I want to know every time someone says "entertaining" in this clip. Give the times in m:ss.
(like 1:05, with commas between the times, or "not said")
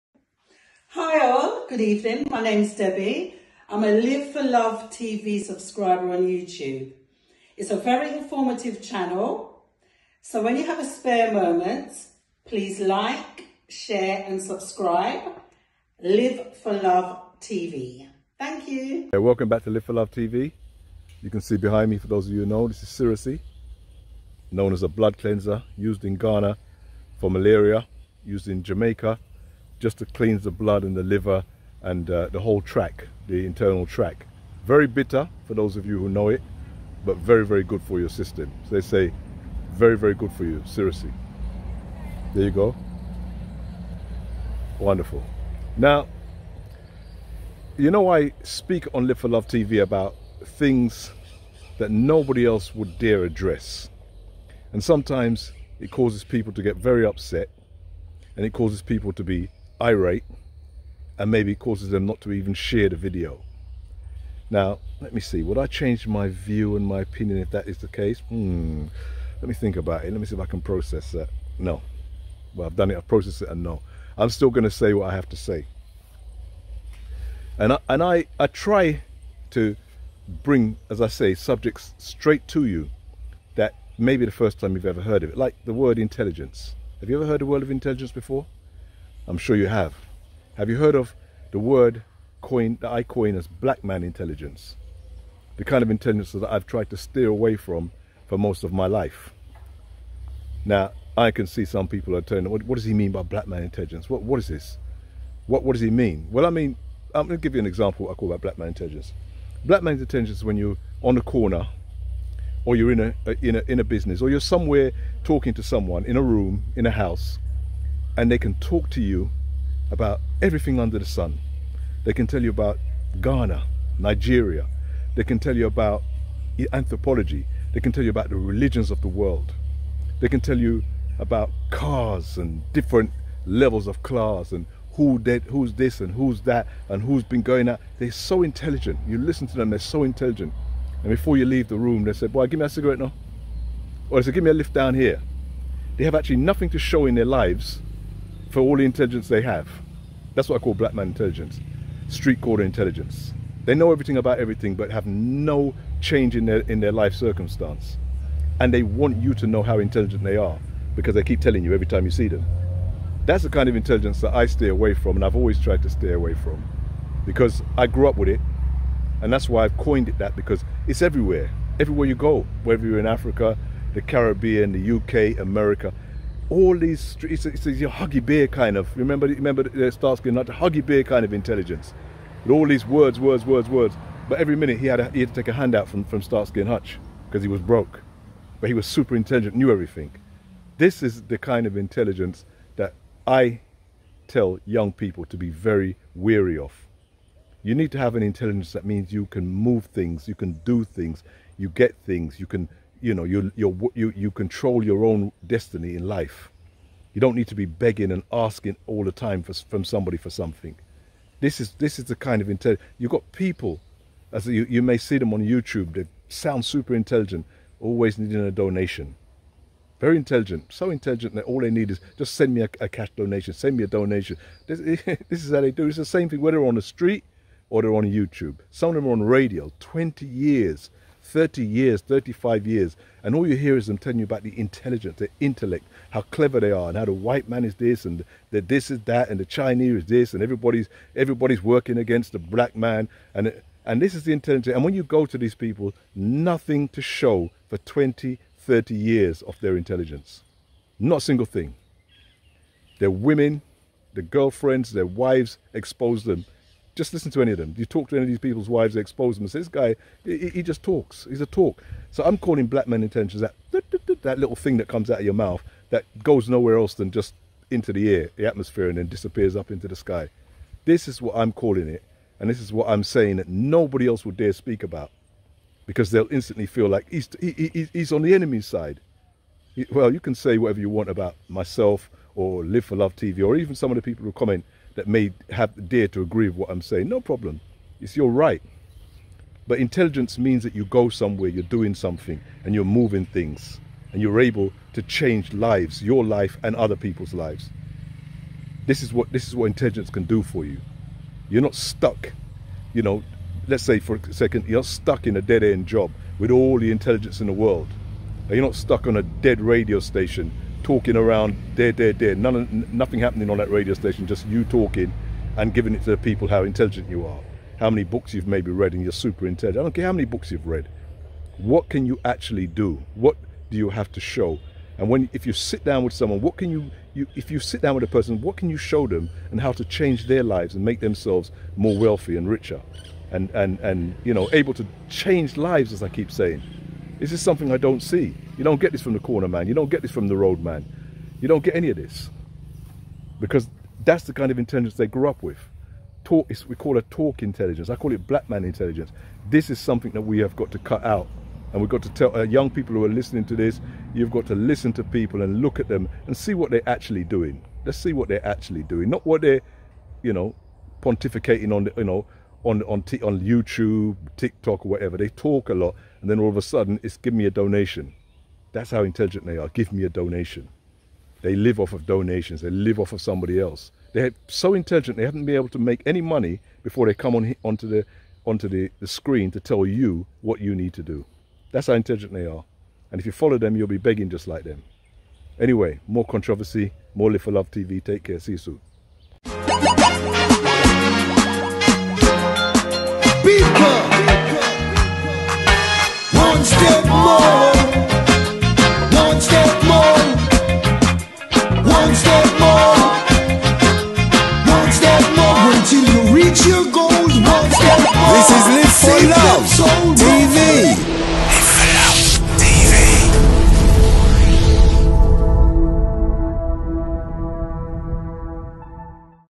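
not said.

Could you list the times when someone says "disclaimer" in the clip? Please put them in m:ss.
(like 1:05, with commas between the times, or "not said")
not said.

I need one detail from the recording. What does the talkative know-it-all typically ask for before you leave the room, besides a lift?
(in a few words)
A cigarette.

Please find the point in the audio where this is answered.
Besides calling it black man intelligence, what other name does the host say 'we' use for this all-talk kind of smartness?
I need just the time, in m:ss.
5:47.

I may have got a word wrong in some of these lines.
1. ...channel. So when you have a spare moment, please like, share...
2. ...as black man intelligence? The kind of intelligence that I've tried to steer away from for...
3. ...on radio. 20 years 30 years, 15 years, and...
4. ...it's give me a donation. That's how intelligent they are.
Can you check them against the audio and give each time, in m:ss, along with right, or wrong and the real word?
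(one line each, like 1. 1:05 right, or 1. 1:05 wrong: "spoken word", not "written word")
1. 0:08 right
2. 1:33 right
3. 3:49 wrong: "35", not "15"
4. 6:07 right.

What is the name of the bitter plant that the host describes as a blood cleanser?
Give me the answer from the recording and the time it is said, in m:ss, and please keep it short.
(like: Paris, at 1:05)
Cerasee, at 0:22.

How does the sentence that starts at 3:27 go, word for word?
You don't need to be begging and asking all the time for, from somebody for something.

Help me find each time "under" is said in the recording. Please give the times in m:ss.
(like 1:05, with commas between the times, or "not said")
2:00.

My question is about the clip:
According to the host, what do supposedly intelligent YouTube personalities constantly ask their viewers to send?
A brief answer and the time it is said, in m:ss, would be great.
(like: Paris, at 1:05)
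A cash donation, at 3:42.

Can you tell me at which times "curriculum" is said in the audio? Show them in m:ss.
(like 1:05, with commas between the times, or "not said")
not said.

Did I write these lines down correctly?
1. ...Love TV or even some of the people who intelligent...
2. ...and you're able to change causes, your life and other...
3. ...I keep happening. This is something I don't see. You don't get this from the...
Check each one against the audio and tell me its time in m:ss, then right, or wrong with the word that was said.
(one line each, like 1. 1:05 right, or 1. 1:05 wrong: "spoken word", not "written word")
1. 4:42 wrong: "comment", not "intelligent"
2. 4:54 wrong: "lives", not "causes"
3. 5:36 wrong: "saying", not "happening".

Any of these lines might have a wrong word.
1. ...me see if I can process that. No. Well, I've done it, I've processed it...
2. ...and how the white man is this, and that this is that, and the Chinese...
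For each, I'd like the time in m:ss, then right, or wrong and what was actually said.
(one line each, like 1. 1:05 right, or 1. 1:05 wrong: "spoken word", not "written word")
1. 1:10 right
2. 3:56 right.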